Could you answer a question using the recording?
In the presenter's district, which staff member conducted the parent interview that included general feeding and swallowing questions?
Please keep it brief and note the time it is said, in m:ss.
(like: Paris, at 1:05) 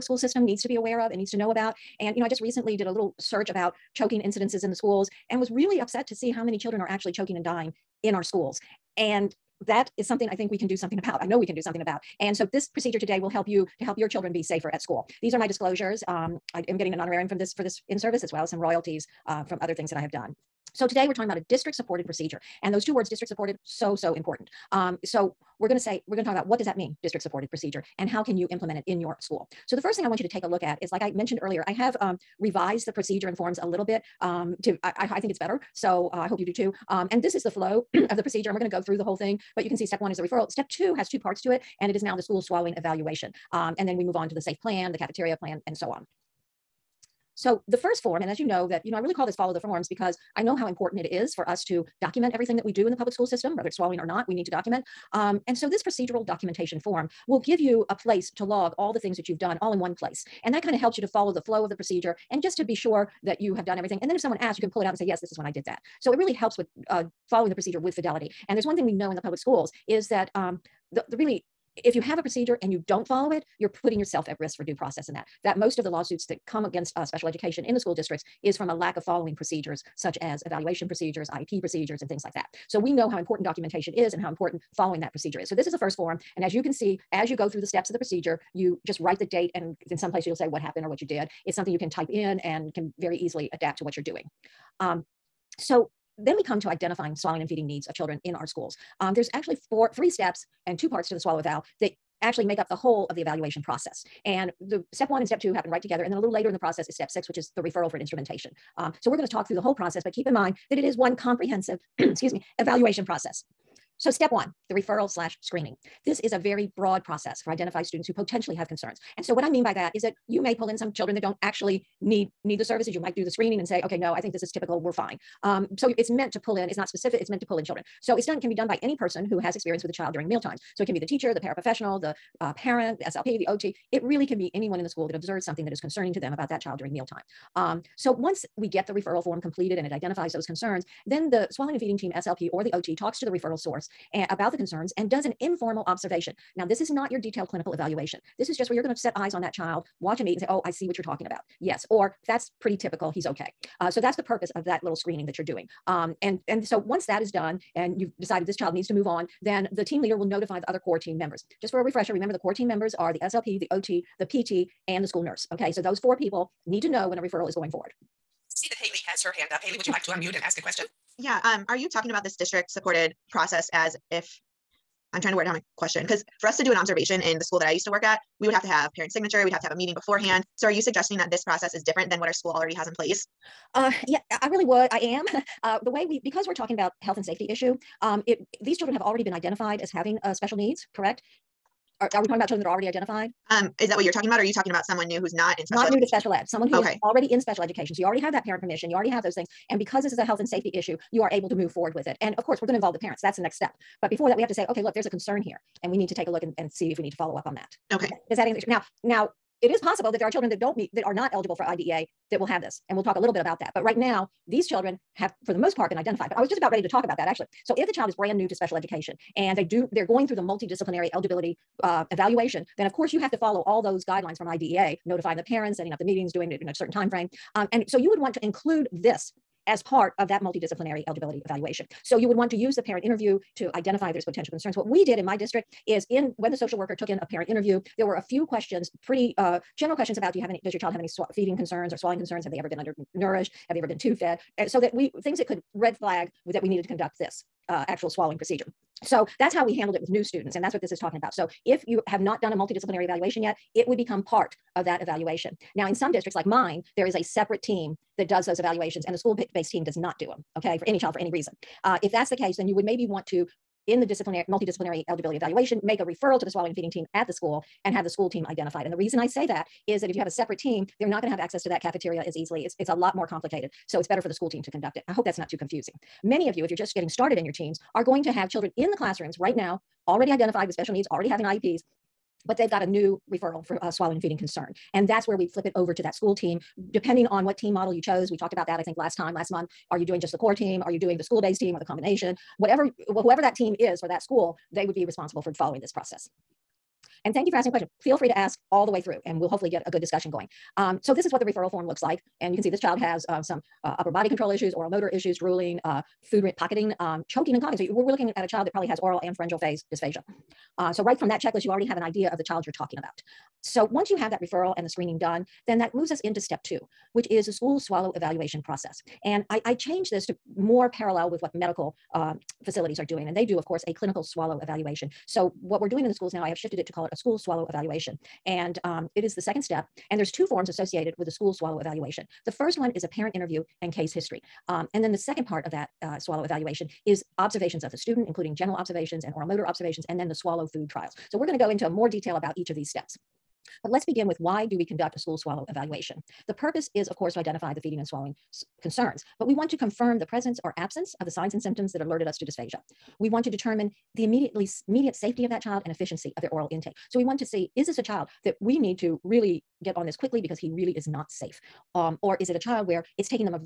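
the social worker, at 3:56.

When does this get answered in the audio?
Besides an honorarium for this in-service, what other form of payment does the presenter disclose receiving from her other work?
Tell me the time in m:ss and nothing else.
0:18.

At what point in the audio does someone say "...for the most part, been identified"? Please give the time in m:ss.
3:35.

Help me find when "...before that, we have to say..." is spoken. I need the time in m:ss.
3:24.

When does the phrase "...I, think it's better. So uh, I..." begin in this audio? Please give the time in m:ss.
0:35.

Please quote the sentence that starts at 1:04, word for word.
And then if someone asks, you can pull it out and say, yes, this is when I did that.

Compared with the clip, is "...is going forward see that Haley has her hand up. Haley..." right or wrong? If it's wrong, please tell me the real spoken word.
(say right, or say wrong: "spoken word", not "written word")
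right.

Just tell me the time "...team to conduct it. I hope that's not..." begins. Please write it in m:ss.
4:34.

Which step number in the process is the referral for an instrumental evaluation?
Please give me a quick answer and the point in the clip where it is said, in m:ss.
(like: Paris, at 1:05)
6, at 1:46.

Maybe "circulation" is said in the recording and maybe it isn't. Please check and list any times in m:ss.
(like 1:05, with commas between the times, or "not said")
not said.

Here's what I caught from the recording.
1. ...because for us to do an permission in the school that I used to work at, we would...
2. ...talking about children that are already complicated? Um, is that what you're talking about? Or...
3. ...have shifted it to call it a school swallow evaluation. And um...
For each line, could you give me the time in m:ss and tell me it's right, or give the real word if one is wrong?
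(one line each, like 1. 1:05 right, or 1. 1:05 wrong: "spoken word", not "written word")
1. 2:56 wrong: "observation", not "permission"
2. 3:12 wrong: "identified", not "complicated"
3. 5:26 right.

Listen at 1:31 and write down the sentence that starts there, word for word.
It's something you can type in and can very easily adapt to what you're doing.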